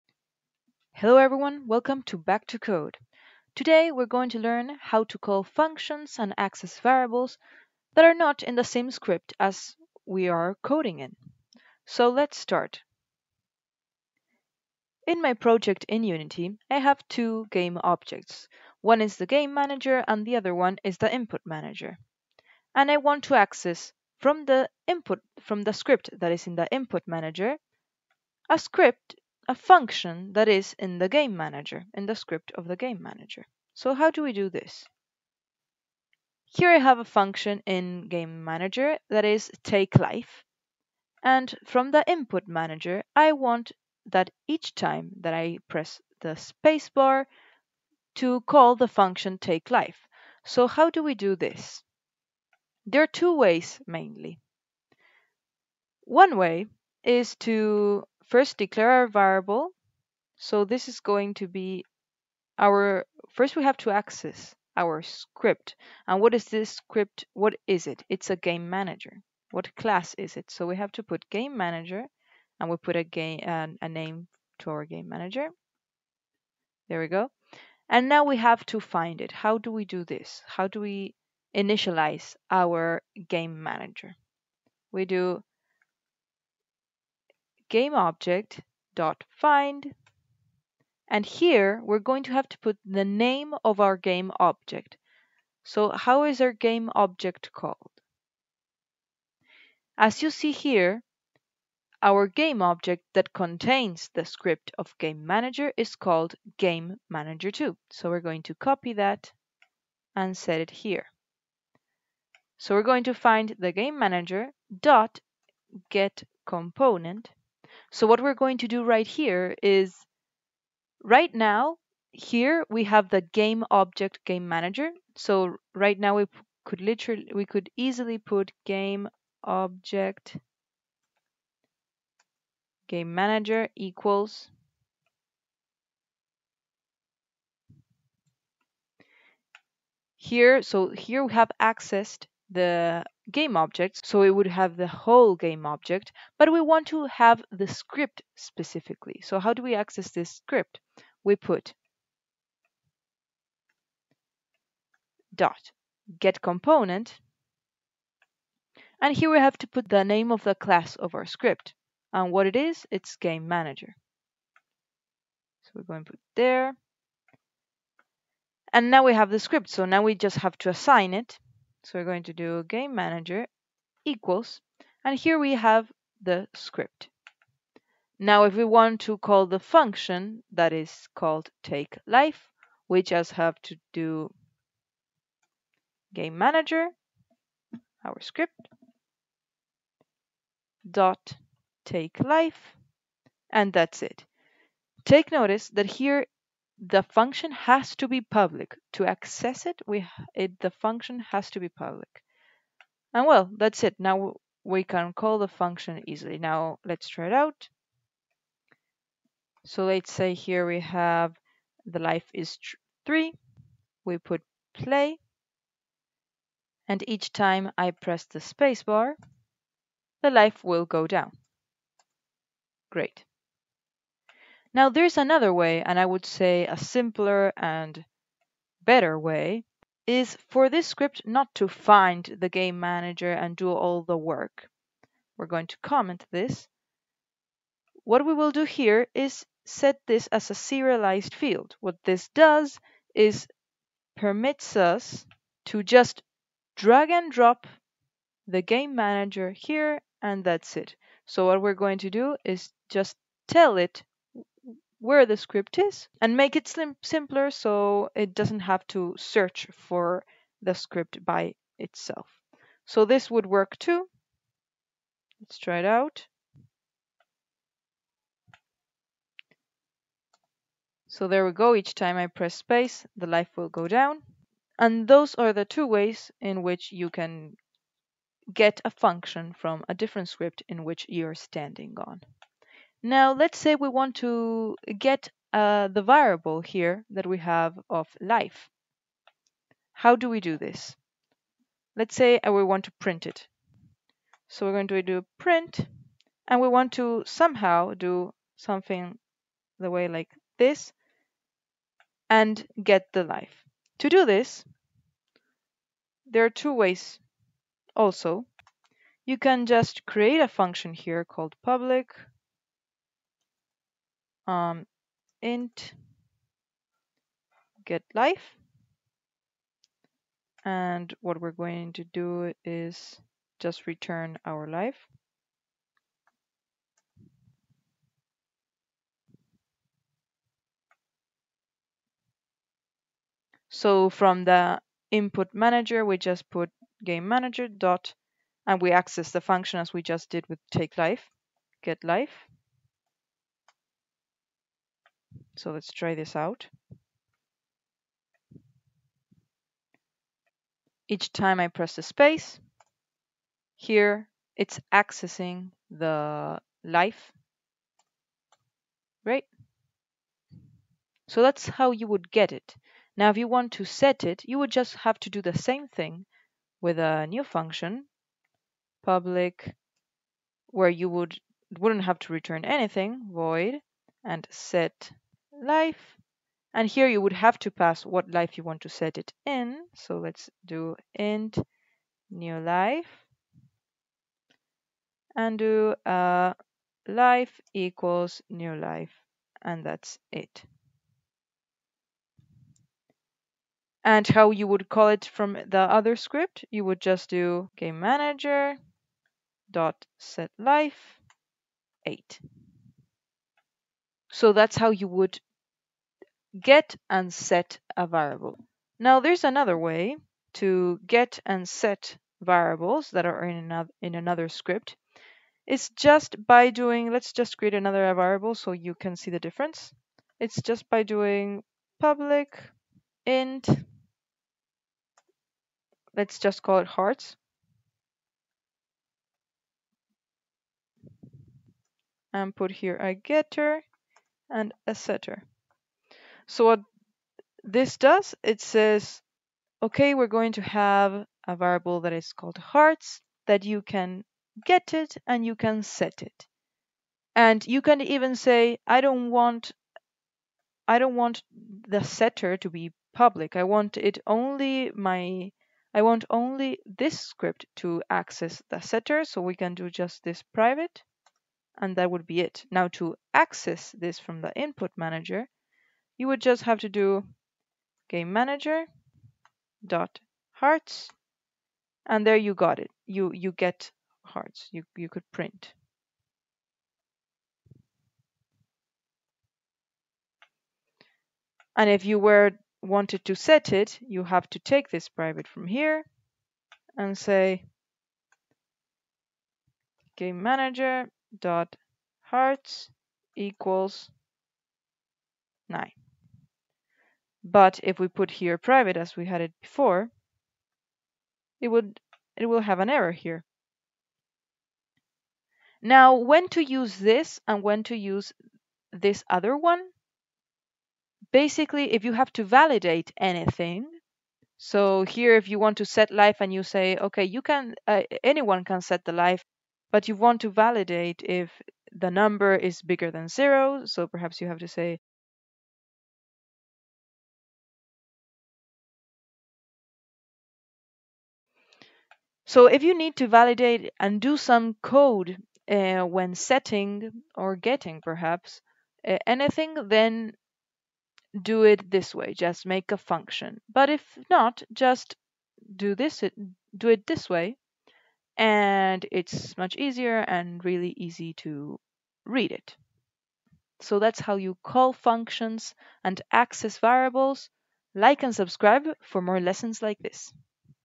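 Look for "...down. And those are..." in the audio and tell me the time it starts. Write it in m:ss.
4:33.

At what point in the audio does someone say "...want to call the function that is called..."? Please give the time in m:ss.
2:58.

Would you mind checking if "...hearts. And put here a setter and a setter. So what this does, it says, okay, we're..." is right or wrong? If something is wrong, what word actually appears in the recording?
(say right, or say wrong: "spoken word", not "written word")
wrong: "getter", not "setter".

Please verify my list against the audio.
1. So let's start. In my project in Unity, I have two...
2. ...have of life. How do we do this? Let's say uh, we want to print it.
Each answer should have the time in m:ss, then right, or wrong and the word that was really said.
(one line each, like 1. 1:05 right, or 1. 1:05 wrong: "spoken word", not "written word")
1. 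0:11 right
2. 4:47 right.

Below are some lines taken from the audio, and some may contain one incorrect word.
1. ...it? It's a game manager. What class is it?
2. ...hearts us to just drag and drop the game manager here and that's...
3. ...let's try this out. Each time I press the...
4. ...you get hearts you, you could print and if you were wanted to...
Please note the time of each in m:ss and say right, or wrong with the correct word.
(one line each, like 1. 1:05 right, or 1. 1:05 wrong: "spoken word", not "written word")
1. 1:07 right
2. 4:04 wrong: "permits", not "hearts"
3. 5:45 right
4. 7:53 right.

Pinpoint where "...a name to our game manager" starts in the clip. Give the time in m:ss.
1:13.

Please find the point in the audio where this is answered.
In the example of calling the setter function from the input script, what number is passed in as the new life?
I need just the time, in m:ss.
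6:42.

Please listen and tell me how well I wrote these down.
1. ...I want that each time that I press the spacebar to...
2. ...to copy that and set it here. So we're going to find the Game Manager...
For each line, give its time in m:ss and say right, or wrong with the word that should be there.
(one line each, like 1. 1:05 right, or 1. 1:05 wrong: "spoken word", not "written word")
1. 0:43 right
2. 1:48 right.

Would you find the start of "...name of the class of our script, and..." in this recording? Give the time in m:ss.
2:40.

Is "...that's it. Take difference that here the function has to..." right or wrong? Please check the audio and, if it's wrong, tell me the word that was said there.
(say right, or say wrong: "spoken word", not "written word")
wrong: "notice", not "difference".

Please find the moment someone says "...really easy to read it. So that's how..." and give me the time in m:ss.
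9:10.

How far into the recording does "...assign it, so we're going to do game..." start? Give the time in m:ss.
2:50.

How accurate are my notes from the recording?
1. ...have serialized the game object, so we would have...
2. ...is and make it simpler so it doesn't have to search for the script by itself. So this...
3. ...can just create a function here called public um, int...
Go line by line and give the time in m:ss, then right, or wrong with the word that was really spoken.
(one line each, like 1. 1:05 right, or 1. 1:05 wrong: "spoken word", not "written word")
1. 2:21 wrong: "accessed", not "serialized"
2. 4:15 right
3. 5:09 right.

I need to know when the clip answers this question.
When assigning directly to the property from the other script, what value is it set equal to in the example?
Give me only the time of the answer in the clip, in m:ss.
8:15.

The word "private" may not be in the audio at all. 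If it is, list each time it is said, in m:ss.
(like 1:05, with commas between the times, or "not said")
7:40, 8:05, 8:18.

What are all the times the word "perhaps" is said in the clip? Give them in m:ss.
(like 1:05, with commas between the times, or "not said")
8:44, 8:58.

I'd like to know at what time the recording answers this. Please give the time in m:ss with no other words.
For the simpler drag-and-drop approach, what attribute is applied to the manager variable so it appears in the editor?
4:00.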